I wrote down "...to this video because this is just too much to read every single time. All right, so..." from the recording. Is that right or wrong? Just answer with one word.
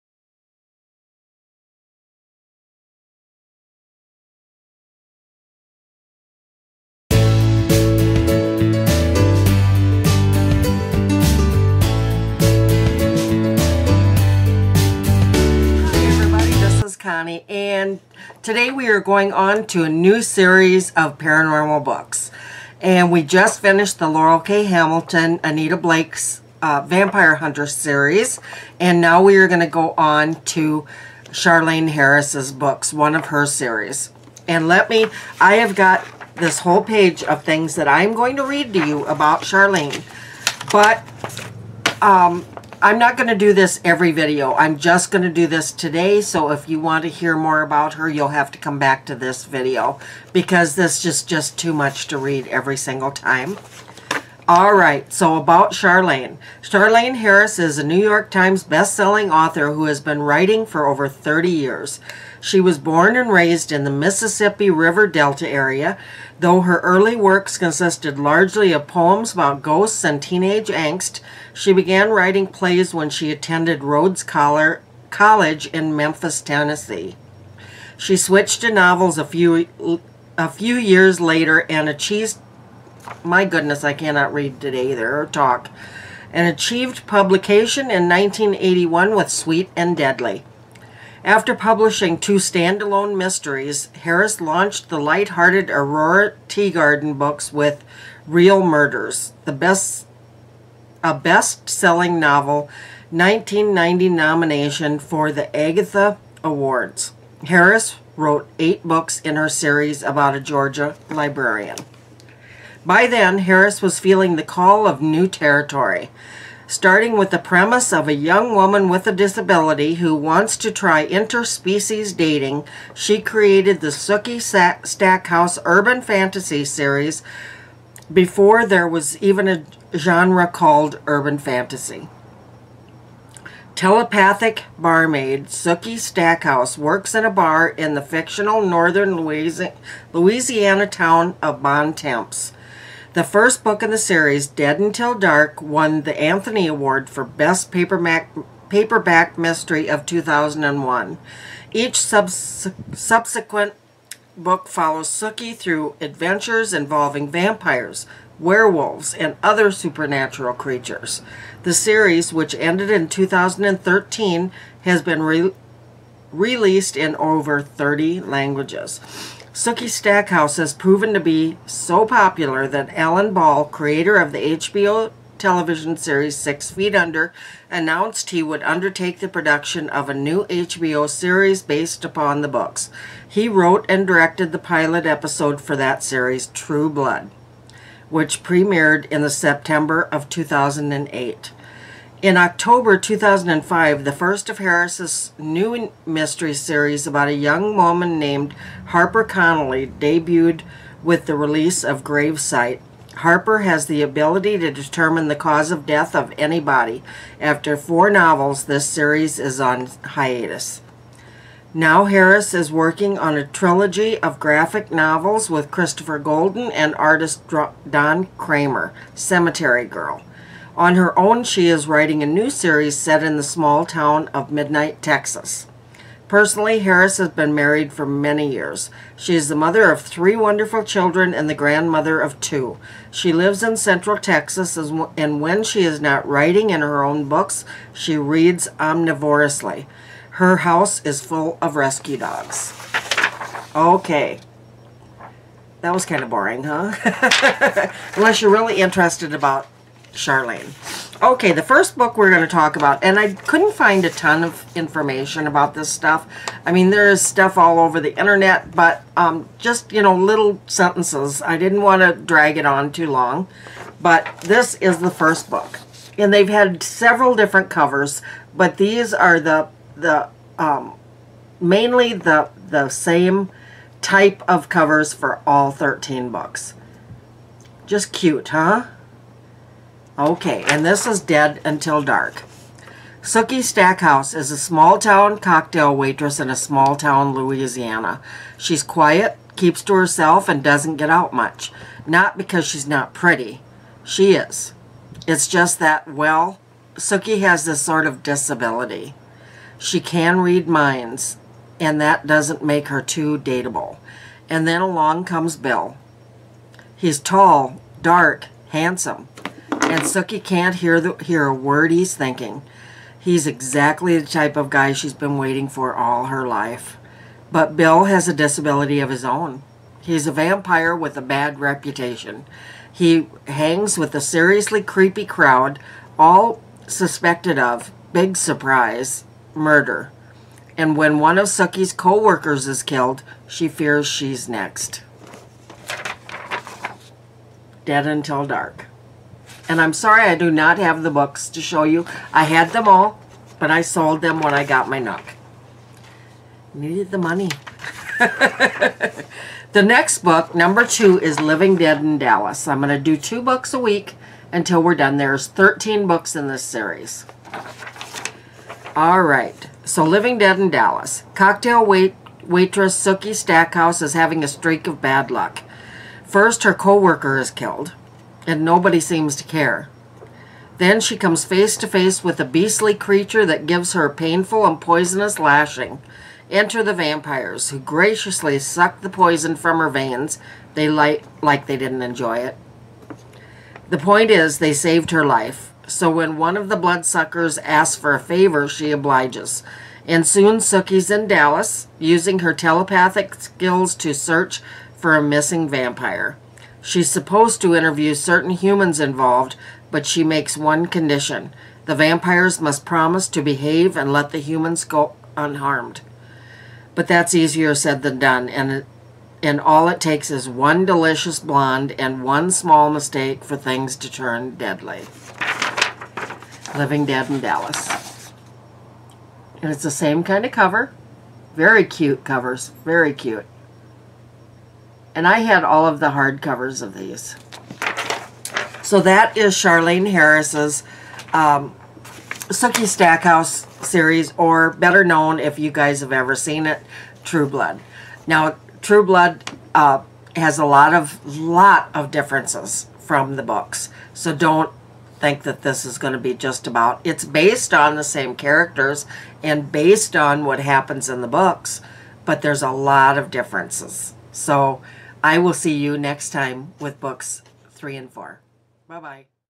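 right.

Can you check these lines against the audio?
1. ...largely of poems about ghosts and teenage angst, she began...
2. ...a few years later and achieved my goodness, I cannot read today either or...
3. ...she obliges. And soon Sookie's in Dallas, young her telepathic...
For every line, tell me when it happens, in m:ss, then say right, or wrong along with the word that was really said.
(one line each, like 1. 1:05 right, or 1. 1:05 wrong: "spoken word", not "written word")
1. 1:08 right
2. 1:20 right
3. 6:28 wrong: "using", not "young".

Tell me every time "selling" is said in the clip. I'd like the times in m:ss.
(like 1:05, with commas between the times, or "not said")
0:58, 1:41.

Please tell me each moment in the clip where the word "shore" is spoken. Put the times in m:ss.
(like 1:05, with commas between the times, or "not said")
not said.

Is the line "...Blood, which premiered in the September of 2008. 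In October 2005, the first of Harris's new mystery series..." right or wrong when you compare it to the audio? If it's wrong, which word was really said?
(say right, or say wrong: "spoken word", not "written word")
right.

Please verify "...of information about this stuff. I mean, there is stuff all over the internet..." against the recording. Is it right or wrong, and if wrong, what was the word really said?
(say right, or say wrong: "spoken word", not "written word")
right.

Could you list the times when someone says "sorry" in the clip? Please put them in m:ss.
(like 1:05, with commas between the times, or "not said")
5:39.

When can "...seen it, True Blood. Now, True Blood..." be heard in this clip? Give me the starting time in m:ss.
7:16.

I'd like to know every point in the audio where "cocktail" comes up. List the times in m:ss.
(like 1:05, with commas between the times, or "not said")
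4:45, 6:01.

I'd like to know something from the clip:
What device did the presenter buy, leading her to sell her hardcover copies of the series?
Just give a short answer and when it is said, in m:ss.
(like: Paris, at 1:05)
Nook, at 5:44.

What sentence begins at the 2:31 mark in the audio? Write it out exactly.
Each subs subsequent book follows Sookie through adventures involving vampires, werewolves, and other supernatural creatures.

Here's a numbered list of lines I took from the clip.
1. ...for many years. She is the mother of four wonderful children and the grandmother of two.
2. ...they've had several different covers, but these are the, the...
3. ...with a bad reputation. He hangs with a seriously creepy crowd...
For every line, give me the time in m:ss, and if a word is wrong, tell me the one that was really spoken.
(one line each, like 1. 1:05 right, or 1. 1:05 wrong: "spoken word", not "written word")
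1. 3:47 wrong: "three", not "four"
2. 4:26 right
3. 5:20 right.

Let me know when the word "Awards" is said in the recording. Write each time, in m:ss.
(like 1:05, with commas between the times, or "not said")
1:46, 2:26.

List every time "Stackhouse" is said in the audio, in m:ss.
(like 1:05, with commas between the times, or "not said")
2:04, 2:15, 2:49, 4:43, 6:03, 7:12.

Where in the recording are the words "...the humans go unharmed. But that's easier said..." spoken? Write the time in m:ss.
6:44.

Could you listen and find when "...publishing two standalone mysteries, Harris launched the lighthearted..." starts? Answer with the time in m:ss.
1:31.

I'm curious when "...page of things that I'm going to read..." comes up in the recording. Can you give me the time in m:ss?
0:36.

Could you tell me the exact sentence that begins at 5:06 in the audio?
He's tall, dark, handsome and Sookie can't hear, the, hear a word he's thinking.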